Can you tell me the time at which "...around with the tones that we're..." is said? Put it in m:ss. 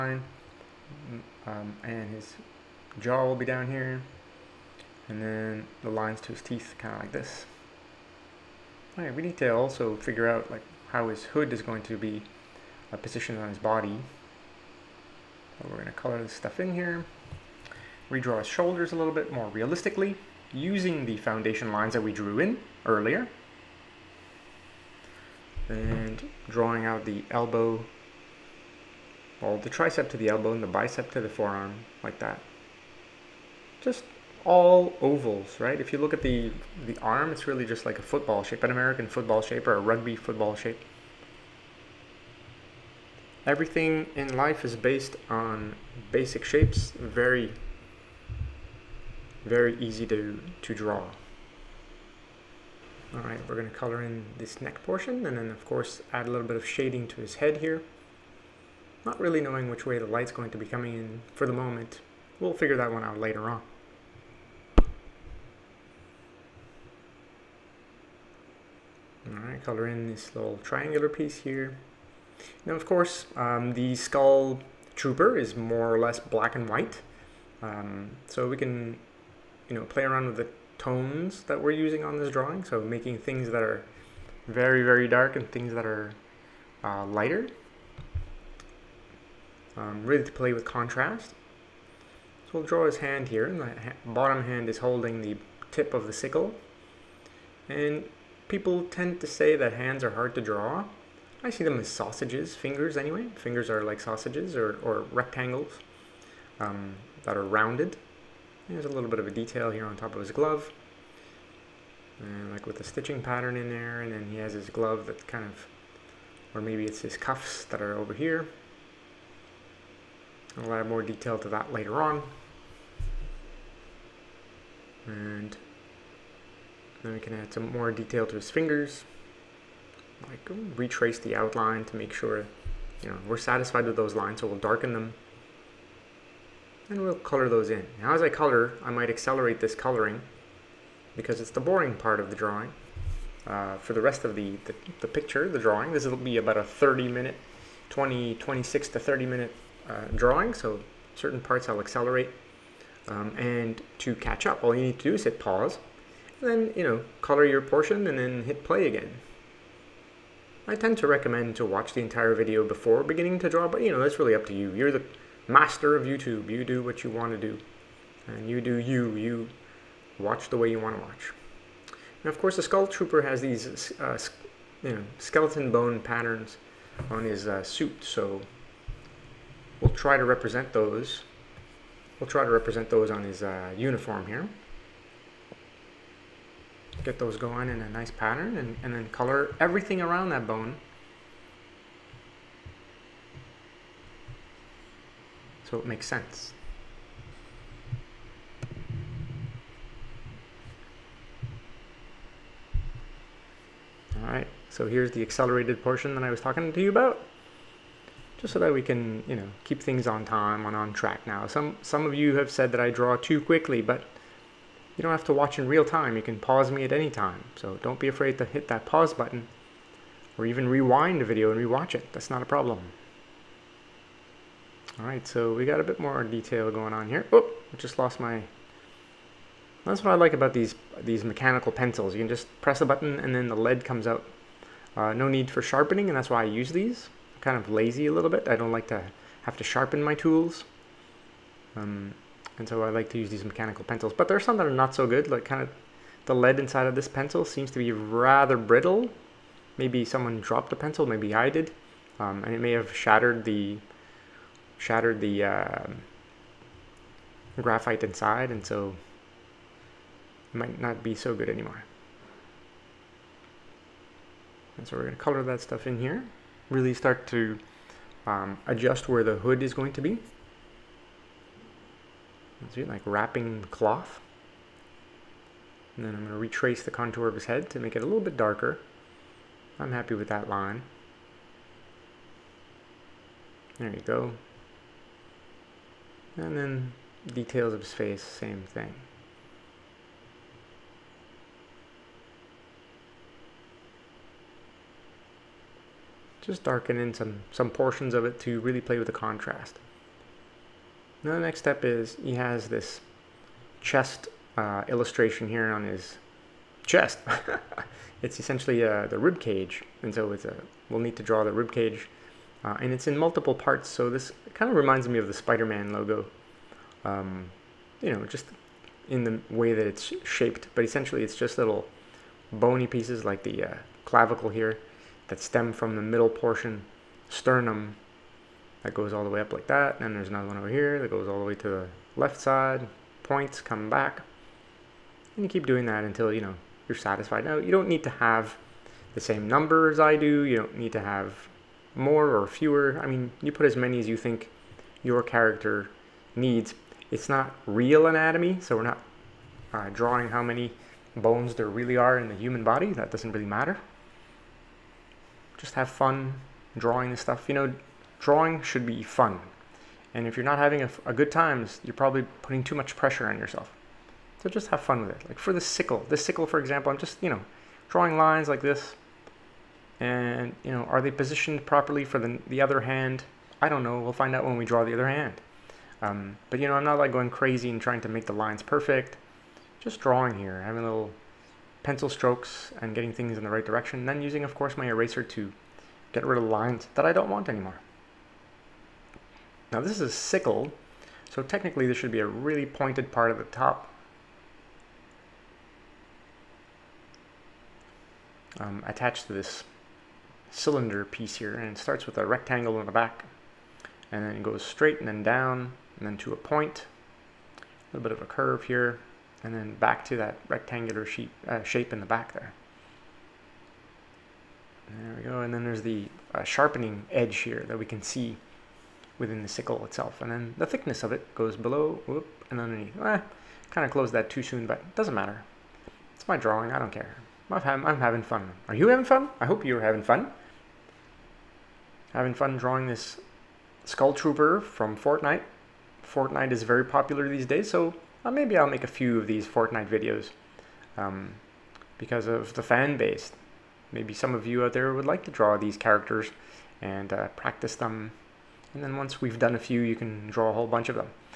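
1:20.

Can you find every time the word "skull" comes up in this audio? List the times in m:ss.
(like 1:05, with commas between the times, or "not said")
1:13, 2:52, 7:13.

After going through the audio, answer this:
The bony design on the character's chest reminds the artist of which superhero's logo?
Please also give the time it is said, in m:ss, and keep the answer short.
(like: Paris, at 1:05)
Spider-Man, at 5:15.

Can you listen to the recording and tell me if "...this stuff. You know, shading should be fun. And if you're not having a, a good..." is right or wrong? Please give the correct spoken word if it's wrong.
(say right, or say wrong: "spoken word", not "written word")
wrong: "drawing", not "shading".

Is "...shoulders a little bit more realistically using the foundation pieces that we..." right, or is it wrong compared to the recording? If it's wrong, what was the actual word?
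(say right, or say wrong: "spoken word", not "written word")
wrong: "lines", not "pieces".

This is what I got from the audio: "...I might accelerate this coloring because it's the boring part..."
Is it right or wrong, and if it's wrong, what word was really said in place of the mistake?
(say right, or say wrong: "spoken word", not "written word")
right.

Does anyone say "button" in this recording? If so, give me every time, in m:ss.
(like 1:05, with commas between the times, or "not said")
3:39, 3:52.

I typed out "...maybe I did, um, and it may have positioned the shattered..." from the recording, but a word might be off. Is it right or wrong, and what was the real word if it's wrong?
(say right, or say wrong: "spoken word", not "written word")
wrong: "shattered", not "positioned".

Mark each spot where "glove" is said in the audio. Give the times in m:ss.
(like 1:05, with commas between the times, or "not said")
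1:50, 1:54.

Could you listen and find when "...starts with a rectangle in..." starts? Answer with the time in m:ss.
6:41.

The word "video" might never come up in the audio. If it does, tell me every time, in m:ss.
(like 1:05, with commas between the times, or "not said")
2:42, 3:41, 7:19.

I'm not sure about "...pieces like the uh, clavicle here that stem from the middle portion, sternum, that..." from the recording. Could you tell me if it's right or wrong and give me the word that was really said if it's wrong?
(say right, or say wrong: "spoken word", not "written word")
right.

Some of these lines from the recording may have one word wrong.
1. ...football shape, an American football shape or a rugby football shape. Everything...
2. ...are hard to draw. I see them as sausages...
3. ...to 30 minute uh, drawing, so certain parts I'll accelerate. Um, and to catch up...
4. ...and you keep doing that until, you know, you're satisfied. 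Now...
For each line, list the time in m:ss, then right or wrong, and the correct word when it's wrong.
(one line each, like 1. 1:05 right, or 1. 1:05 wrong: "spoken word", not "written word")
1. 0:38 right
2. 1:40 right
3. 2:28 right
4. 5:35 right.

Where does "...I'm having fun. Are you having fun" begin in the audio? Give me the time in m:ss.
7:07.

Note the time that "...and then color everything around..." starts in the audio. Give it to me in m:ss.
3:08.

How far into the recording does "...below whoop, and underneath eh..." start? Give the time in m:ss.
7:01.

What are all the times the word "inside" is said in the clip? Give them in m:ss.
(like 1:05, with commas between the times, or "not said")
4:06, 4:18.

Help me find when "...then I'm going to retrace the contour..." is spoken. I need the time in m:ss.
4:36.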